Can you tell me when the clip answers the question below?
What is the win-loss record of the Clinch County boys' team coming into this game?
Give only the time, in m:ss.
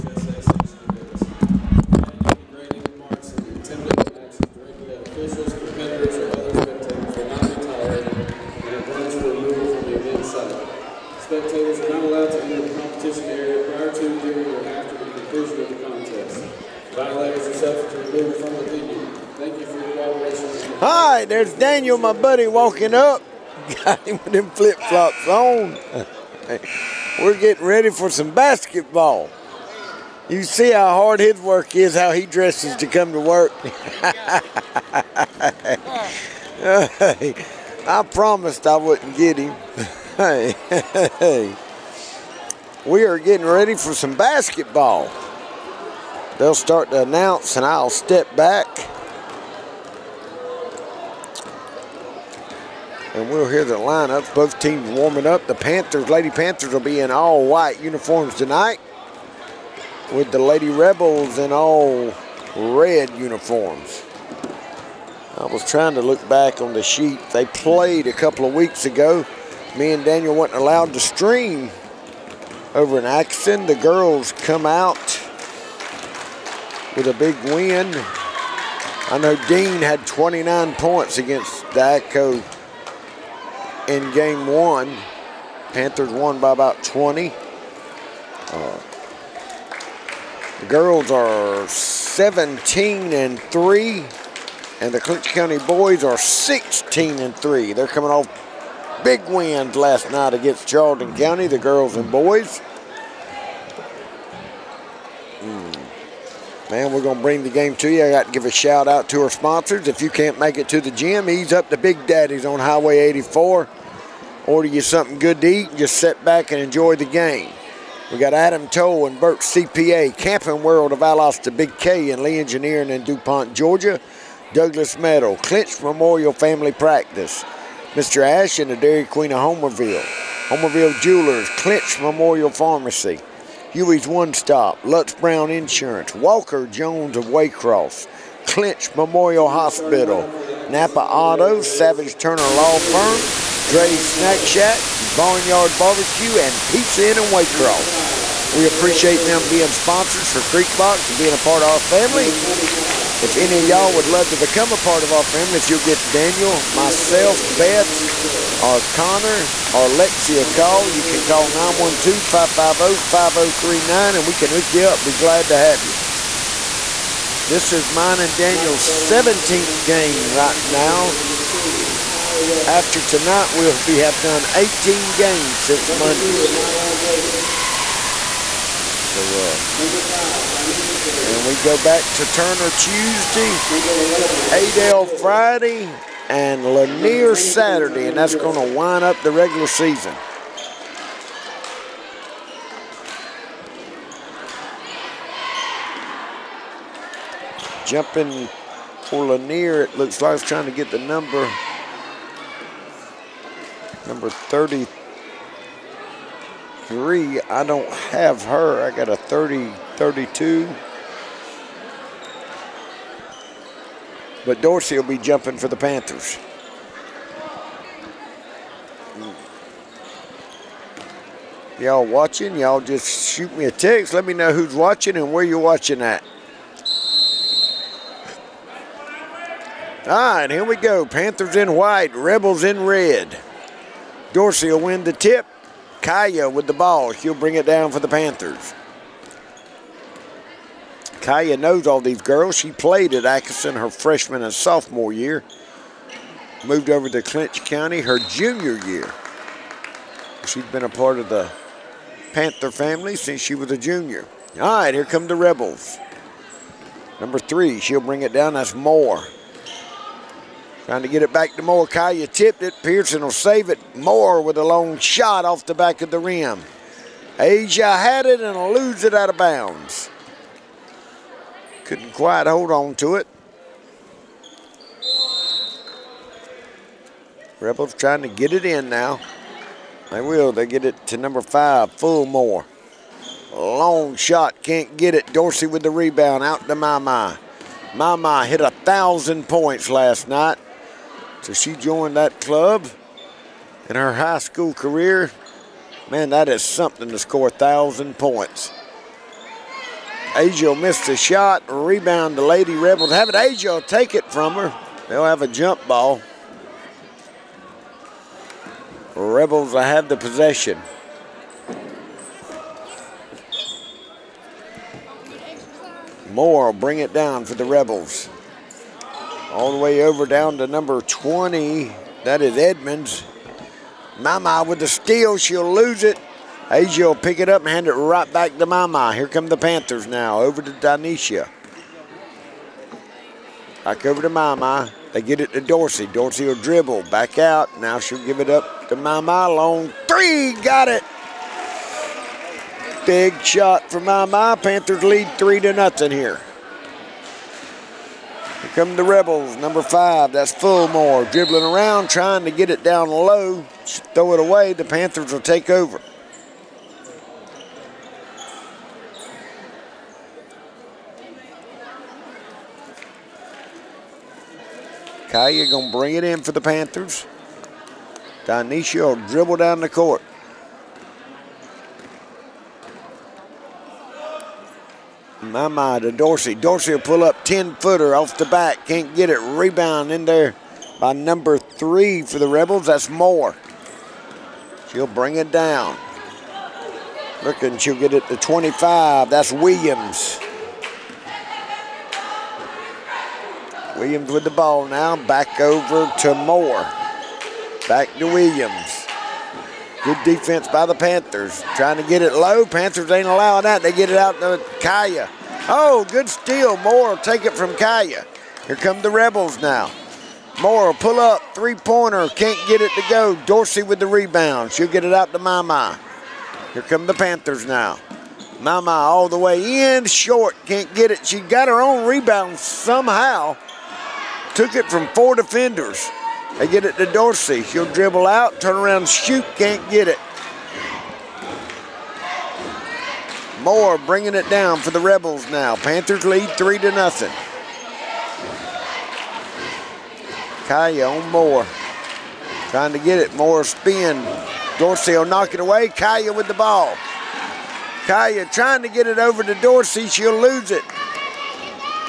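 1:36.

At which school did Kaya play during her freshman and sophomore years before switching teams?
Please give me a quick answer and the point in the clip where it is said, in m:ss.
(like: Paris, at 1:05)
Atkinson, at 4:03.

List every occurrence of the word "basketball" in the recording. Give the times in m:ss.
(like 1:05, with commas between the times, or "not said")
0:28, 0:44.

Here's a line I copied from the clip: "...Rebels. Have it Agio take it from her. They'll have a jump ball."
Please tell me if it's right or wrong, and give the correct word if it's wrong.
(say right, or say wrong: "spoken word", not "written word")
right.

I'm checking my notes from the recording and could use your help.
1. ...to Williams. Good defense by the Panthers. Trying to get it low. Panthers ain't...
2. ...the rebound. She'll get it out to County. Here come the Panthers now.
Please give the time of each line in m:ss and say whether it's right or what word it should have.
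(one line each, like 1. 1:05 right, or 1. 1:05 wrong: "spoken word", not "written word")
1. 6:38 right
2. 6:53 wrong: "Mama", not "County".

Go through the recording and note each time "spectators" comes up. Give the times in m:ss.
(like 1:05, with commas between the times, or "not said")
0:06, 0:11.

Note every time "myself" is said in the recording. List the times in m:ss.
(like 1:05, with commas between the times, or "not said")
2:36.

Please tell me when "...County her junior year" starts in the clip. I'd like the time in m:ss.
4:07.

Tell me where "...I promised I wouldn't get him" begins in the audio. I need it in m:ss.
0:37.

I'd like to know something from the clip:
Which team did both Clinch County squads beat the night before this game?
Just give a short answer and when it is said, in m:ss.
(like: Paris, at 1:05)
Charlton County, at 1:40.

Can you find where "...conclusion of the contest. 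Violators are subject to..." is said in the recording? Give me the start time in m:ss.
0:15.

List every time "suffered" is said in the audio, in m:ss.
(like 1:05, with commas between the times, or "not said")
not said.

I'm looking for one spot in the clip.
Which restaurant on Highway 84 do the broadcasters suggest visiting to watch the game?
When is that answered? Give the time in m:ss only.
1:51.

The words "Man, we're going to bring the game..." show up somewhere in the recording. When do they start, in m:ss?
1:46.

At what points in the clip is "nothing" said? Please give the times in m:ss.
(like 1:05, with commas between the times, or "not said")
5:45, 7:16.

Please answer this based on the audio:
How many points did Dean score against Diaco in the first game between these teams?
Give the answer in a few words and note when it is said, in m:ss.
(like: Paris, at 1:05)
29, at 1:20.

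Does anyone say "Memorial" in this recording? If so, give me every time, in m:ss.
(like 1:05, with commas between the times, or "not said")
2:05, 2:11, 2:18.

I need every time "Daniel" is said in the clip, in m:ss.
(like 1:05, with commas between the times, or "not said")
0:21, 1:10, 2:36, 2:48.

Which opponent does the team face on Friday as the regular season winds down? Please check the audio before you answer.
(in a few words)
Adel.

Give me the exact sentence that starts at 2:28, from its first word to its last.
We appreciate them being sponsors for Creek Box and being a part of our family.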